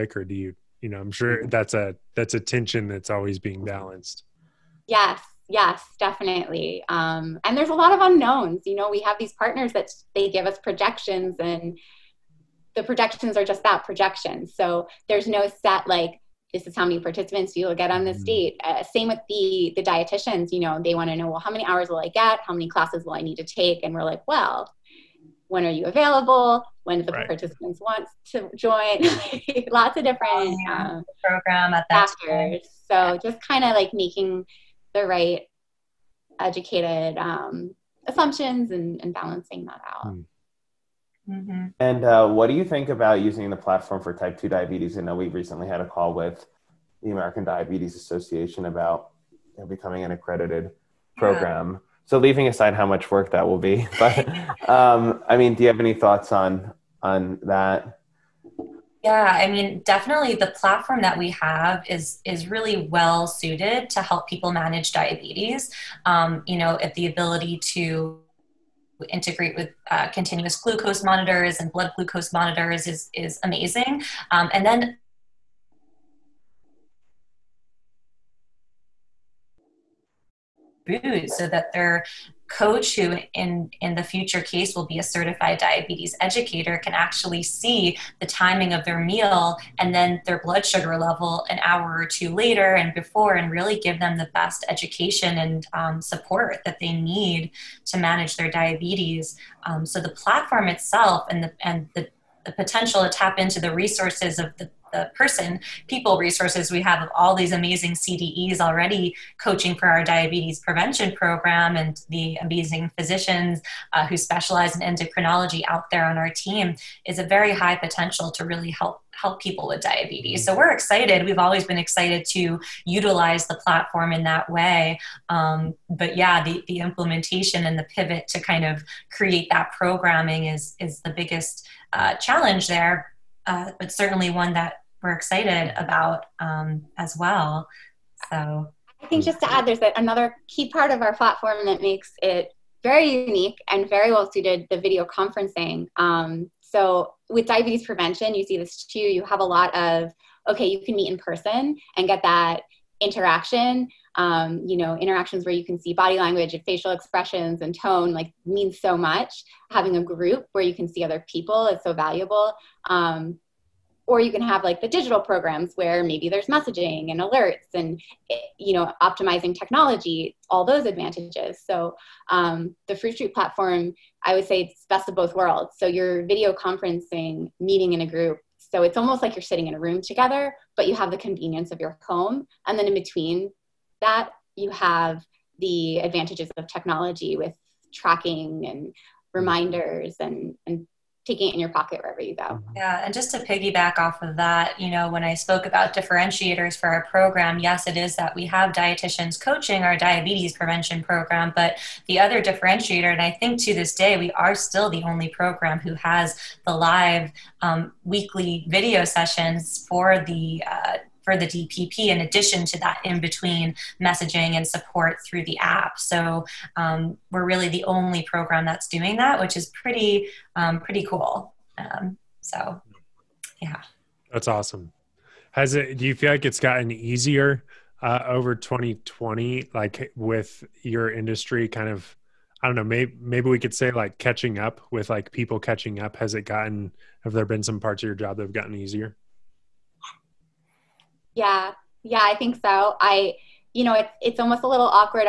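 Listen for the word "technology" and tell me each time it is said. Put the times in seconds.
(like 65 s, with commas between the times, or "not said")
169 s, 186 s.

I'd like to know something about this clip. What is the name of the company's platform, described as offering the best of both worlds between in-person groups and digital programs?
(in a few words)
Fruit Street.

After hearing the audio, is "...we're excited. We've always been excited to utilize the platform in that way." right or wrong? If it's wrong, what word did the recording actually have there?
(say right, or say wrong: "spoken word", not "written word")
right.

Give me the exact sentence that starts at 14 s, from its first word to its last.
So there's no set like this is how many participants you will get on this mm-hmm.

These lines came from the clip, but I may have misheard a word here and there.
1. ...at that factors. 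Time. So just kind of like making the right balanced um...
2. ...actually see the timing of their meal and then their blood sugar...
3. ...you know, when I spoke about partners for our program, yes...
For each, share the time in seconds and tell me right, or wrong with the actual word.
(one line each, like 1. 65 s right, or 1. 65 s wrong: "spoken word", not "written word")
1. 31 s wrong: "educated", not "balanced"
2. 86 s right
3. 194 s wrong: "differentiators", not "partners".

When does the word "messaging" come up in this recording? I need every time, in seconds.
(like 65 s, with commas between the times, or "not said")
166 s, 214 s.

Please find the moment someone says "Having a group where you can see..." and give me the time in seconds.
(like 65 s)
159 s.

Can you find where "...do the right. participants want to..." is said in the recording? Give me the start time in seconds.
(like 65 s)
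26 s.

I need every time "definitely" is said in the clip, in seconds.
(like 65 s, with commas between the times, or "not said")
6 s, 59 s.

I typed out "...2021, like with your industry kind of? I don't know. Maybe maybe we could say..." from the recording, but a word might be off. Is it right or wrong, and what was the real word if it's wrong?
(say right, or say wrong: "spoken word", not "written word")
wrong: "2020", not "2021".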